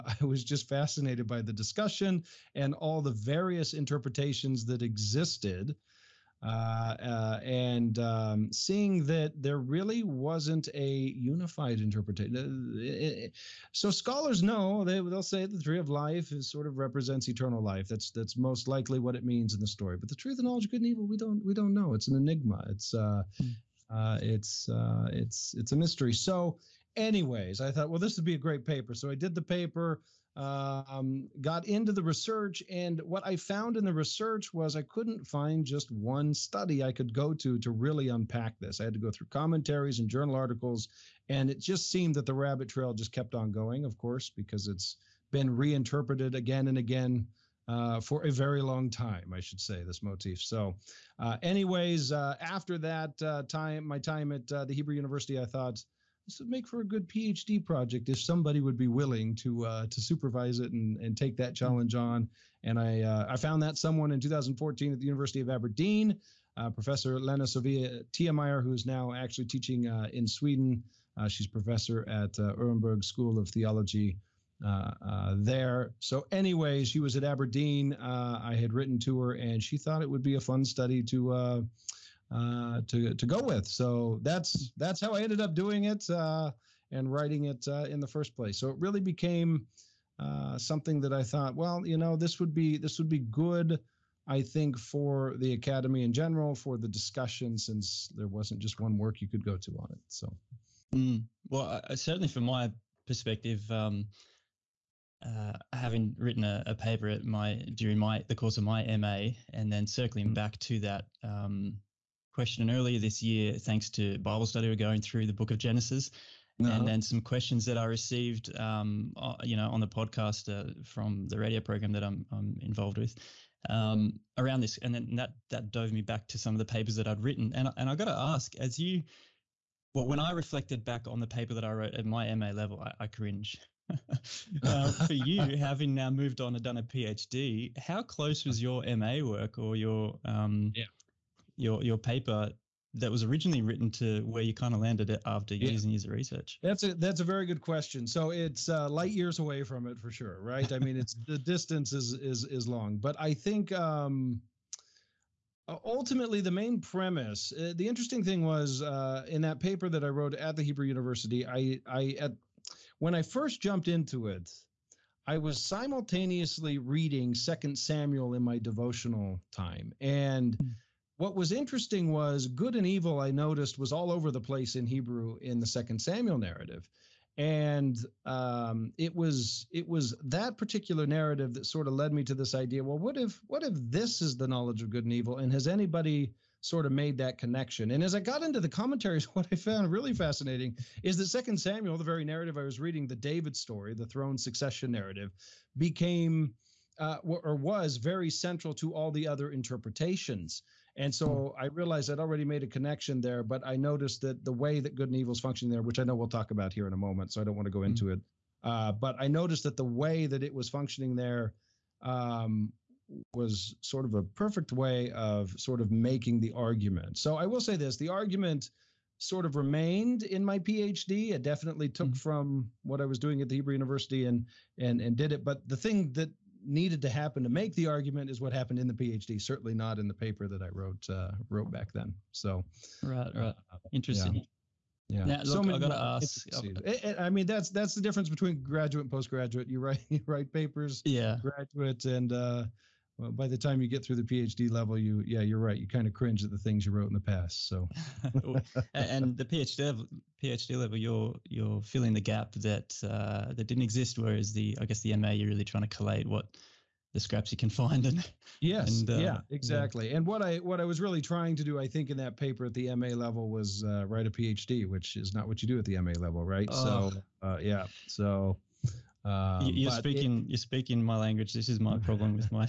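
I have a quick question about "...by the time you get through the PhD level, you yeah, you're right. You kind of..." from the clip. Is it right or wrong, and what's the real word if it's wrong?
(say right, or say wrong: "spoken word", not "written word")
right.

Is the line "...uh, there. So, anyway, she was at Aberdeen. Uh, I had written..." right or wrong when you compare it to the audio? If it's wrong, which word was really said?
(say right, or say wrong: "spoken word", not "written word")
right.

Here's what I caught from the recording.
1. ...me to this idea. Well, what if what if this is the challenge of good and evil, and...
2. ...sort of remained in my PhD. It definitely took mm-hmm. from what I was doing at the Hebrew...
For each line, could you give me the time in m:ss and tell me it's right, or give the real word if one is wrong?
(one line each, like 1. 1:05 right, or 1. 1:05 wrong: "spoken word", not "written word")
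1. 3:02 wrong: "knowledge", not "challenge"
2. 3:39 right.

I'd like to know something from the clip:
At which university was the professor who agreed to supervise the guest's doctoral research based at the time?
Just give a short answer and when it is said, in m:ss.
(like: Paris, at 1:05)
University of Aberdeen, at 1:05.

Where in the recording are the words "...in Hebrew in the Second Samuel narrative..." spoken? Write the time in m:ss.
2:54.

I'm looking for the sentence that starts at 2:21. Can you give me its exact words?
your your paper that was originally written to where you kind of landed it after yeah.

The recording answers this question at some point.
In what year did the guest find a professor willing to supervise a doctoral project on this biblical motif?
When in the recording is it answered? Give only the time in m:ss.
1:04.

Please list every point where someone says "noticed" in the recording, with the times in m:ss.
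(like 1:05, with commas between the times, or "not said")
2:53, 3:23, 3:29.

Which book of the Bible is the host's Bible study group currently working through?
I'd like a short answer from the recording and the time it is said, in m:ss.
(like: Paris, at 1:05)
Genesis, at 1:55.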